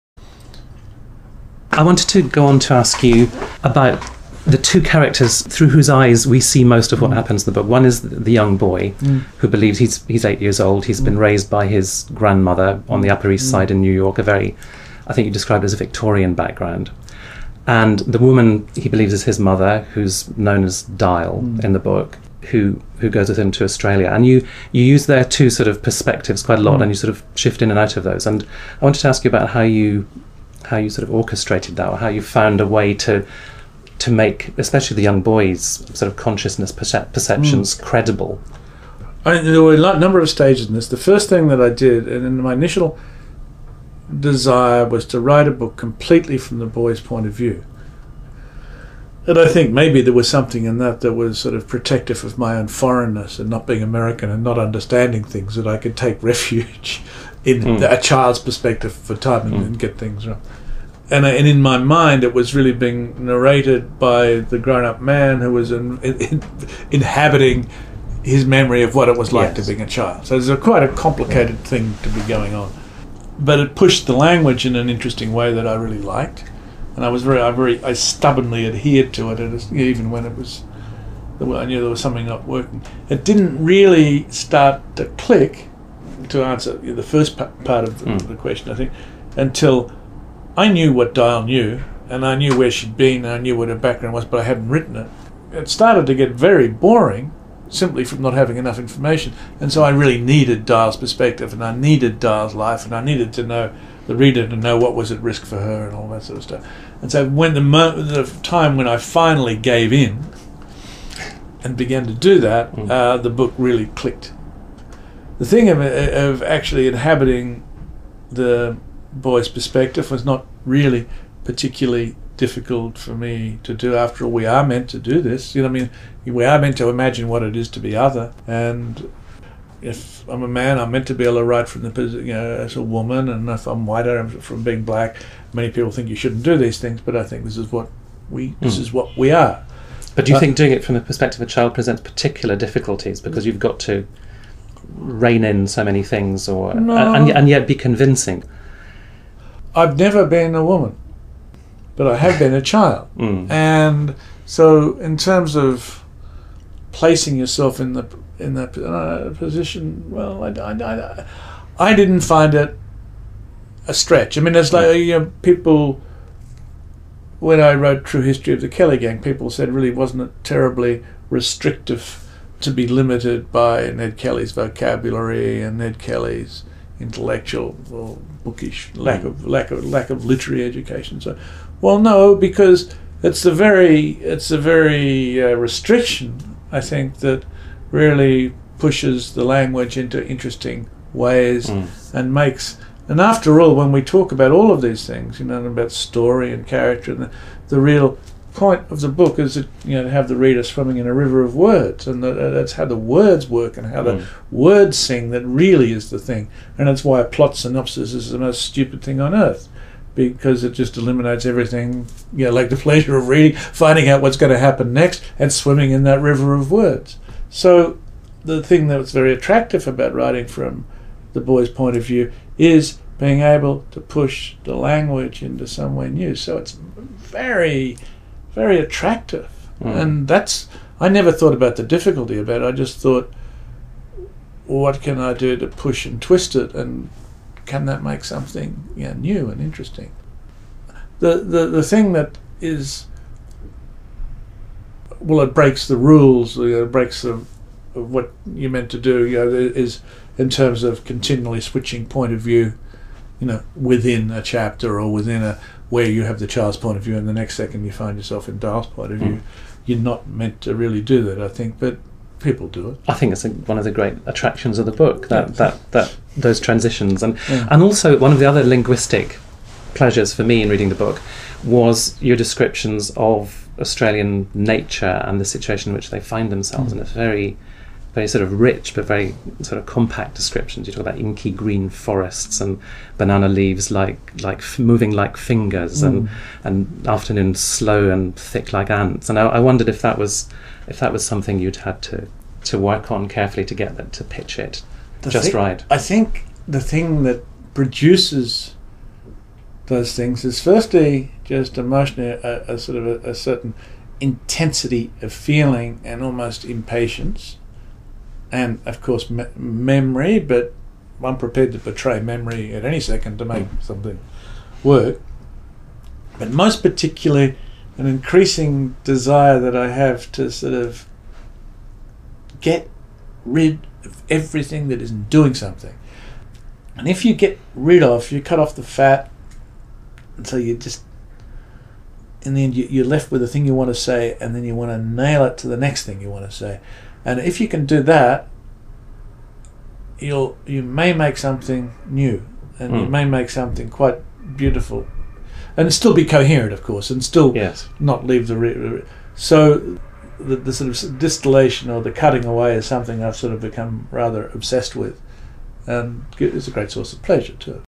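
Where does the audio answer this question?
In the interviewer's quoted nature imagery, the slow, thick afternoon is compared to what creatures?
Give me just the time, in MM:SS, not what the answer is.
04:48.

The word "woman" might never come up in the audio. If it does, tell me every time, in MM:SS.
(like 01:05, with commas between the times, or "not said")
00:18, 02:12, 02:30.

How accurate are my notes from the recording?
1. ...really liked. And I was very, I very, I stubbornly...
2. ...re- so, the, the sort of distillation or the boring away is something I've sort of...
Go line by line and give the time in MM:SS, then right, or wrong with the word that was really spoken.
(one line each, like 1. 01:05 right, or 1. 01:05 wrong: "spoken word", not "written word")
1. 01:15 right
2. 05:48 wrong: "cutting", not "boring".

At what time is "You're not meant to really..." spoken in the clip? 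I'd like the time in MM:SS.
04:19.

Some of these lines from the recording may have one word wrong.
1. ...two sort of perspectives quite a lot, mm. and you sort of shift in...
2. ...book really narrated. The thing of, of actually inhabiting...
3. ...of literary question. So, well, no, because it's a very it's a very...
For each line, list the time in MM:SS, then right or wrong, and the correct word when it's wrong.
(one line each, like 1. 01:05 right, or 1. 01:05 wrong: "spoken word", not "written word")
1. 00:25 right
2. 01:53 wrong: "clicked", not "narrated"
3. 03:00 wrong: "education", not "question".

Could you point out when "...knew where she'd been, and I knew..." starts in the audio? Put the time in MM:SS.
01:32.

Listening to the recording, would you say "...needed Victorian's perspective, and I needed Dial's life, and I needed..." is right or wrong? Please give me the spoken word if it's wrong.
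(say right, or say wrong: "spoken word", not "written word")
wrong: "Dial", not "Victorian".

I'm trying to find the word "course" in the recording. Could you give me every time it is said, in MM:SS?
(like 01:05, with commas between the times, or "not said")
05:09, 05:46.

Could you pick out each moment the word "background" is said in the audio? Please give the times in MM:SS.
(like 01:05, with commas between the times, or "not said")
00:16, 01:33.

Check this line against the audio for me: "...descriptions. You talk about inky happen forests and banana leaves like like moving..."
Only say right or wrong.
wrong.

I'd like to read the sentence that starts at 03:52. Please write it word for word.
I just thought, what can I do to push and twist it?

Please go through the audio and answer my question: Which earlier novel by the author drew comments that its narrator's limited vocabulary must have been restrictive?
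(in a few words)
True History of the Kelly Gang.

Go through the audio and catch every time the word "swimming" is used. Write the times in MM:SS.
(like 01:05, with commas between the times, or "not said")
03:20, 03:35.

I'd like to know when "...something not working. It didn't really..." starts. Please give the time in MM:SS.
01:22.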